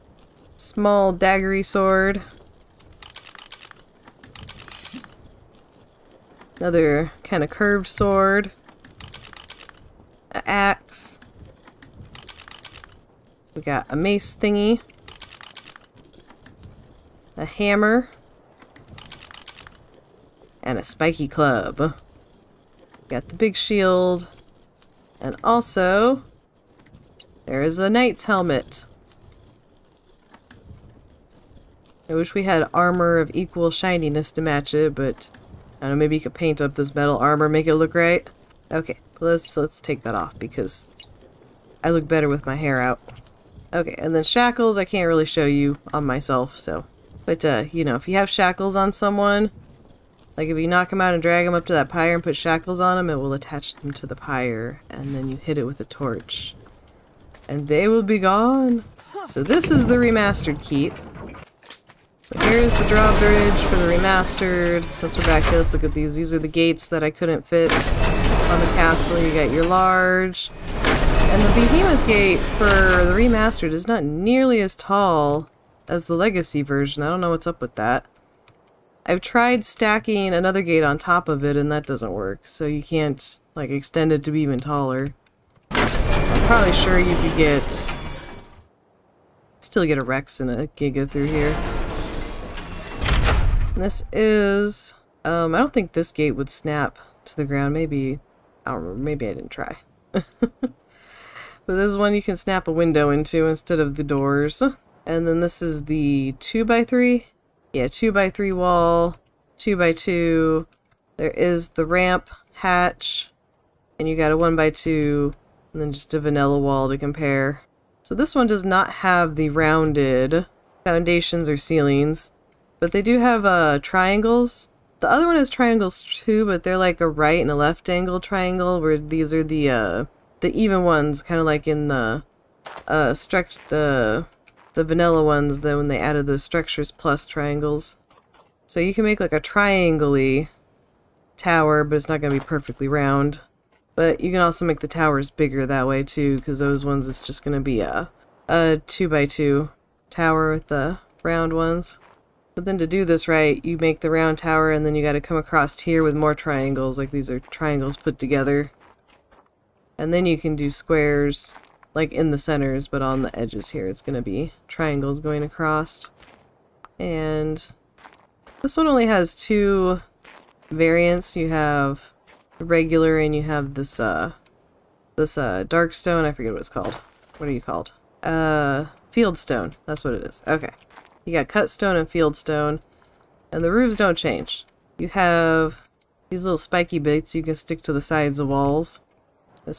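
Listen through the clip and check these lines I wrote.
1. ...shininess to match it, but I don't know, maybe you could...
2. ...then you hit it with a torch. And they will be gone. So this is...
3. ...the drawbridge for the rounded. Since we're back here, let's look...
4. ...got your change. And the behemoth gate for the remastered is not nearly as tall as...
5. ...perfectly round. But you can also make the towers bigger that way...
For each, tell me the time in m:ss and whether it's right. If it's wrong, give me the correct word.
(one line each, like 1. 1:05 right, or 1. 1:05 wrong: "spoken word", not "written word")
1. 0:33 right
2. 0:55 right
3. 1:02 wrong: "remastered", not "rounded"
4. 1:09 wrong: "large", not "change"
5. 2:22 right.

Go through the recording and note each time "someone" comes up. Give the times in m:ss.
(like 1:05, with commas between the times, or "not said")
0:48.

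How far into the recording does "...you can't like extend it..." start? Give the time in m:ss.
1:22.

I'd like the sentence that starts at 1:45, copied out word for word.
And then this is the 2 by 3 yeah, two by three wall, two by two.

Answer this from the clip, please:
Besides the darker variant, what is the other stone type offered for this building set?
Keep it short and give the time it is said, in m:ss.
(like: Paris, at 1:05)
Cut stone, at 3:01.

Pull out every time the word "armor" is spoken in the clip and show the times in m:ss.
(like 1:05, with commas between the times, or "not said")
0:32, 0:37.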